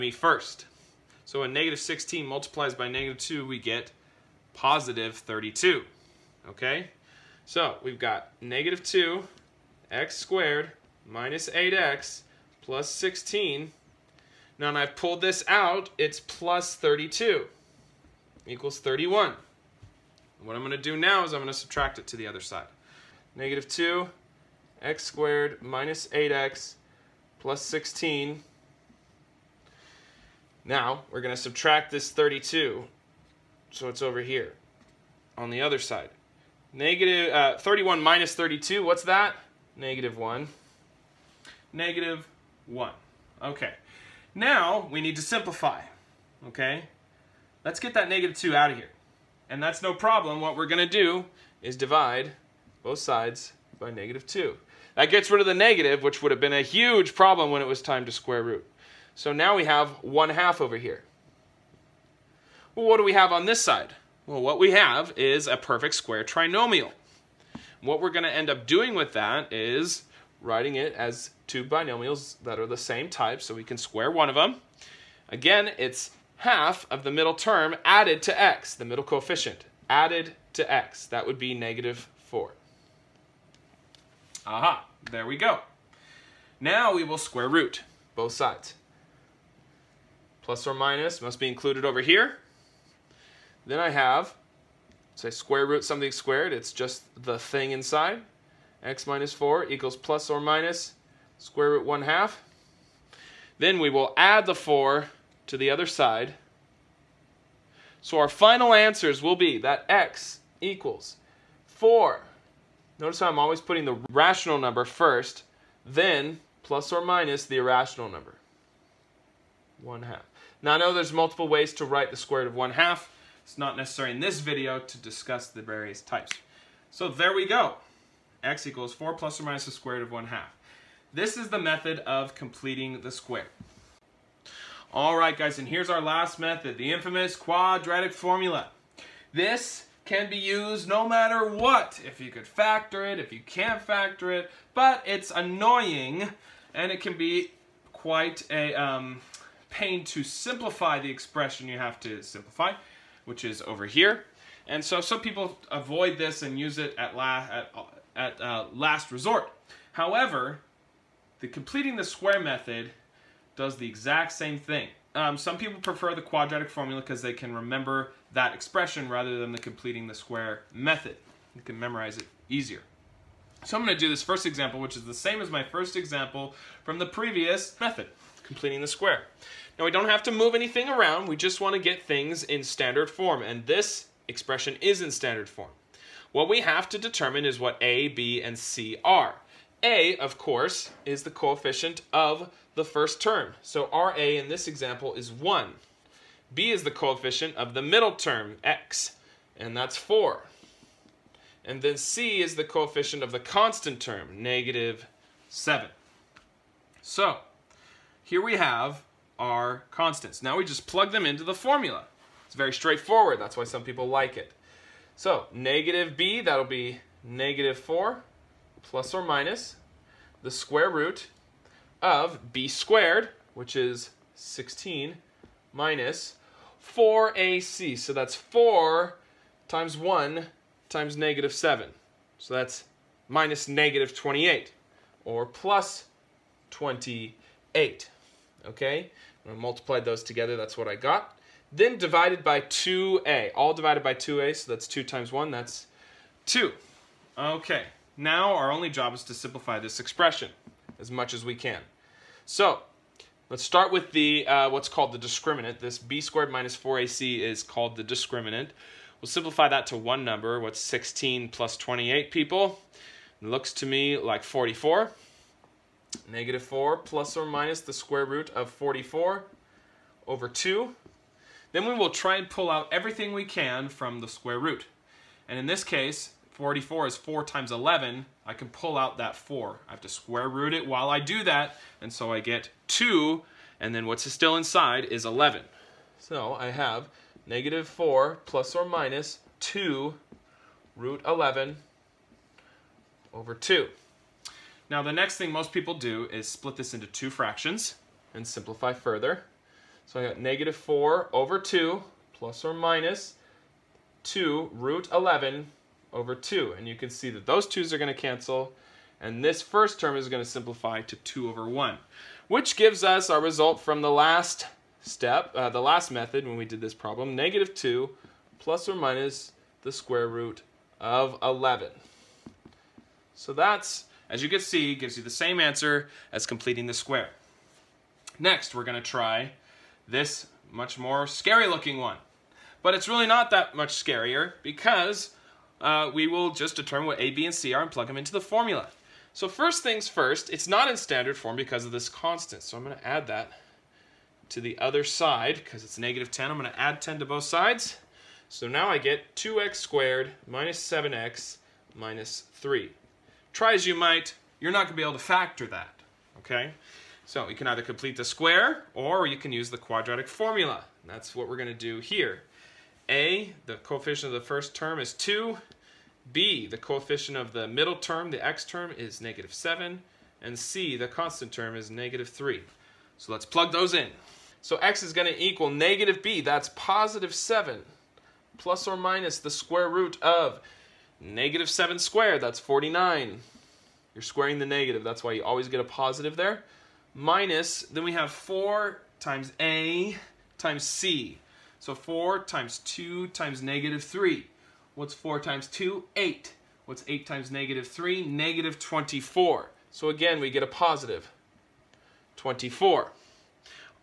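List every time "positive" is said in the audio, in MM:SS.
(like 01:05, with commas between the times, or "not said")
00:04, 06:16, 06:25, 06:40.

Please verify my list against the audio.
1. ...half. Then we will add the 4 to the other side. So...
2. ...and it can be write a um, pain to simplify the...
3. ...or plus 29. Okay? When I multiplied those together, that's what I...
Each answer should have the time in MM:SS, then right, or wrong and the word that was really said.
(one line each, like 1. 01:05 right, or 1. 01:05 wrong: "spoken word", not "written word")
1. 01:42 right
2. 02:26 wrong: "quite", not "write"
3. 03:55 wrong: "28", not "29".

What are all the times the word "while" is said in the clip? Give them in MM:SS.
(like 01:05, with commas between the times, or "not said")
04:40.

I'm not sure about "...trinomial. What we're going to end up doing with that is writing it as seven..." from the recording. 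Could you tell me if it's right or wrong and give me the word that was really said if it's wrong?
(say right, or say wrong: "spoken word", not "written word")
wrong: "two", not "seven".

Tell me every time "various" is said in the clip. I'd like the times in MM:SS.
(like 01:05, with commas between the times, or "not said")
02:05.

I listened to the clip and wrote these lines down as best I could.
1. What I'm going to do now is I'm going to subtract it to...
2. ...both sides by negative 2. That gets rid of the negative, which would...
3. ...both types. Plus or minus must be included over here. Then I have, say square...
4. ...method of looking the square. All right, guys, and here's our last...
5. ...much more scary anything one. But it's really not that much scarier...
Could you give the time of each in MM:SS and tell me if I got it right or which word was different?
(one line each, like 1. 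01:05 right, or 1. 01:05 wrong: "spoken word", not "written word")
1. 00:20 right
2. 00:52 right
3. 01:28 wrong: "sides", not "types"
4. 02:11 wrong: "completing", not "looking"
5. 05:30 wrong: "looking", not "anything".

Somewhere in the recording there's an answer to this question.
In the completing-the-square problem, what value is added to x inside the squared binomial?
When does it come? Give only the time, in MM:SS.
01:21.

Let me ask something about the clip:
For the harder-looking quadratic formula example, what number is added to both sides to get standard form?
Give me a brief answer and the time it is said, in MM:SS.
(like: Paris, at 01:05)
10, at 05:46.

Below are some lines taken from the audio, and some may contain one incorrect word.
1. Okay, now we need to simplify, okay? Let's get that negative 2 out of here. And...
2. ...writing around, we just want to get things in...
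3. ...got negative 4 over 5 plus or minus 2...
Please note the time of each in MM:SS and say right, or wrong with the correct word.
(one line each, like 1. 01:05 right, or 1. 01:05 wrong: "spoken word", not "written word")
1. 00:43 right
2. 03:00 wrong: "anything", not "writing"
3. 05:00 wrong: "2", not "5".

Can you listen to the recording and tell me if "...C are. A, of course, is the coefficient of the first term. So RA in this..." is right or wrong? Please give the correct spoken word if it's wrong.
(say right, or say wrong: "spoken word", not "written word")
right.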